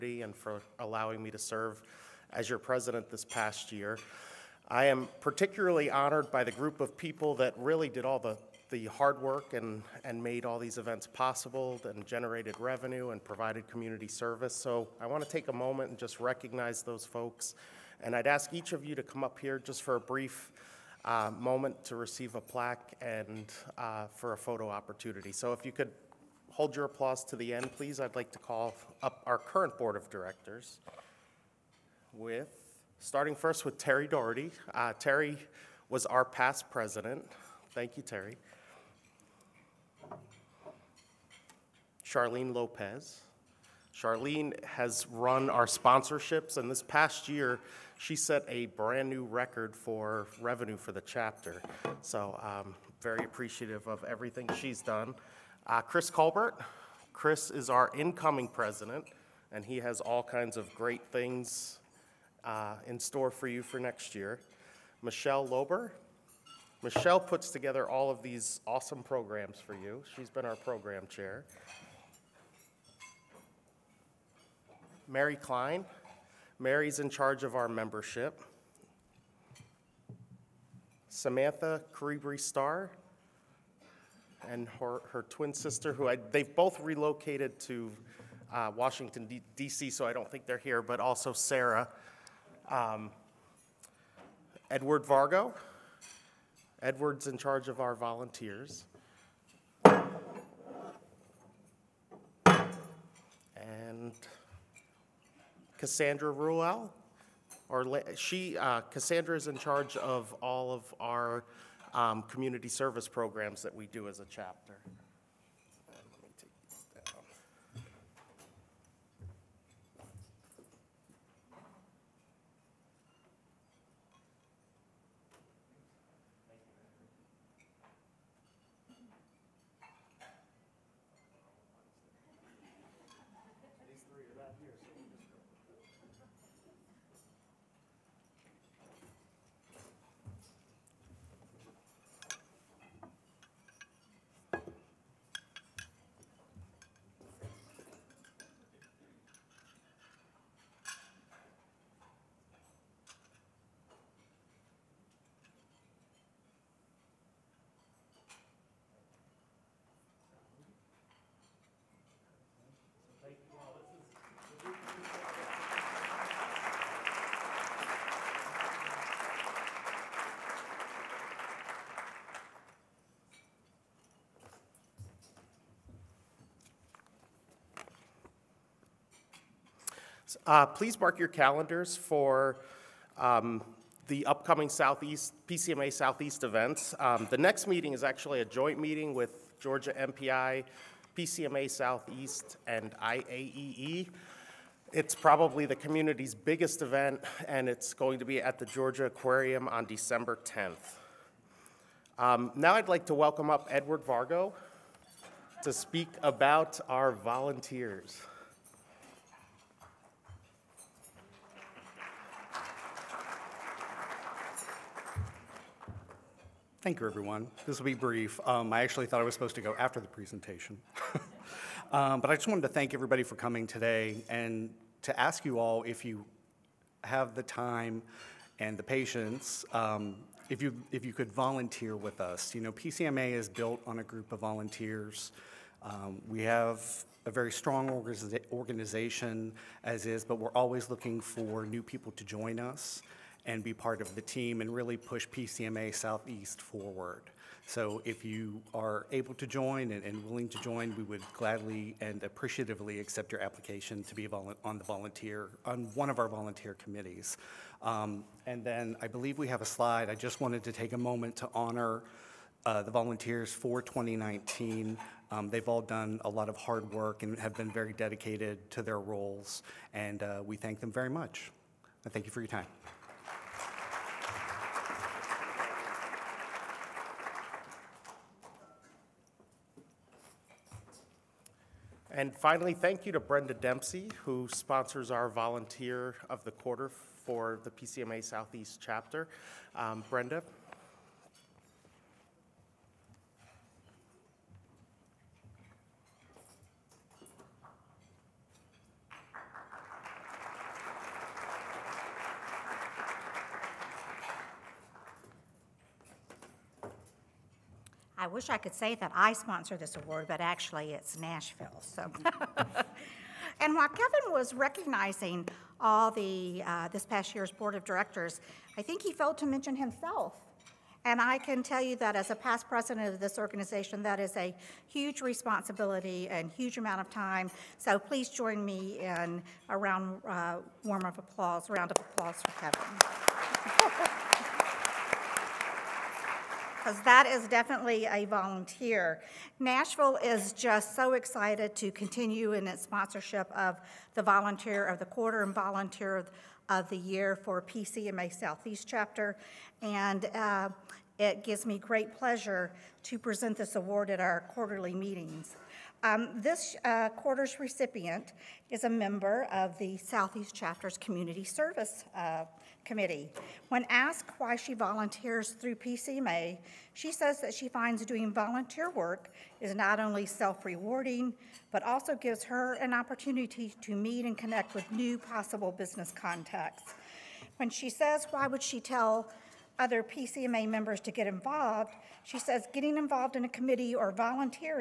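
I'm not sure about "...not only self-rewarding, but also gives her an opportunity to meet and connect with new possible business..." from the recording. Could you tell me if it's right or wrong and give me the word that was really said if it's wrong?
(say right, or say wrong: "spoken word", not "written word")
right.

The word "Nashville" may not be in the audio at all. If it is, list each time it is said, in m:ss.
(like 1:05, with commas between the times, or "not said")
5:11, 5:39.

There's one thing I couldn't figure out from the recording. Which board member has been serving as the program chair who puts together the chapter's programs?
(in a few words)
Michelle Lober.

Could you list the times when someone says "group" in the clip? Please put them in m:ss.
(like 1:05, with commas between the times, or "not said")
0:06, 3:54.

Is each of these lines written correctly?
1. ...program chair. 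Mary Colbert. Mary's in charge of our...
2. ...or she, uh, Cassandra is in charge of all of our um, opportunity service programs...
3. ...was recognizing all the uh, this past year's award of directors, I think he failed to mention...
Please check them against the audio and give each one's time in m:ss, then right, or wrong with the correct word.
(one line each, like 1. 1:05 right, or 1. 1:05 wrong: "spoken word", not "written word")
1. 1:10 wrong: "Klein", not "Colbert"
2. 1:47 wrong: "community", not "opportunity"
3. 5:14 wrong: "board", not "award".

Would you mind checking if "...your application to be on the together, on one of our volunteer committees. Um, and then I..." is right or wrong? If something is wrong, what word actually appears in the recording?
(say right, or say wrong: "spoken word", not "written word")
wrong: "volunteer", not "together".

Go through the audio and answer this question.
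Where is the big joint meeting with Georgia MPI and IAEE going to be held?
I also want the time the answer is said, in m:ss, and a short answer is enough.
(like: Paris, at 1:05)
Georgia Aquarium, at 3:18.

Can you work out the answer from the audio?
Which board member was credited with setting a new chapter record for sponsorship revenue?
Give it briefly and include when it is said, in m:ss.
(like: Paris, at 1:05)
Charlene Lopez, at 0:42.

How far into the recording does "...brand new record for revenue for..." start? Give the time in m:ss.
0:48.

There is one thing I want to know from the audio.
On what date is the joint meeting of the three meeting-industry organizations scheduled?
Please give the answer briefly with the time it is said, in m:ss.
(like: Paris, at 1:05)
December 10, at 3:19.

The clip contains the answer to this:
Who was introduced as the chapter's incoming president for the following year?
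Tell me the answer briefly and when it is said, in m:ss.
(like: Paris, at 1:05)
Chris Colbert, at 0:55.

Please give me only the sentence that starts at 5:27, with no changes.
So please join me in a round uh, warm of applause, round of applause for Kevin.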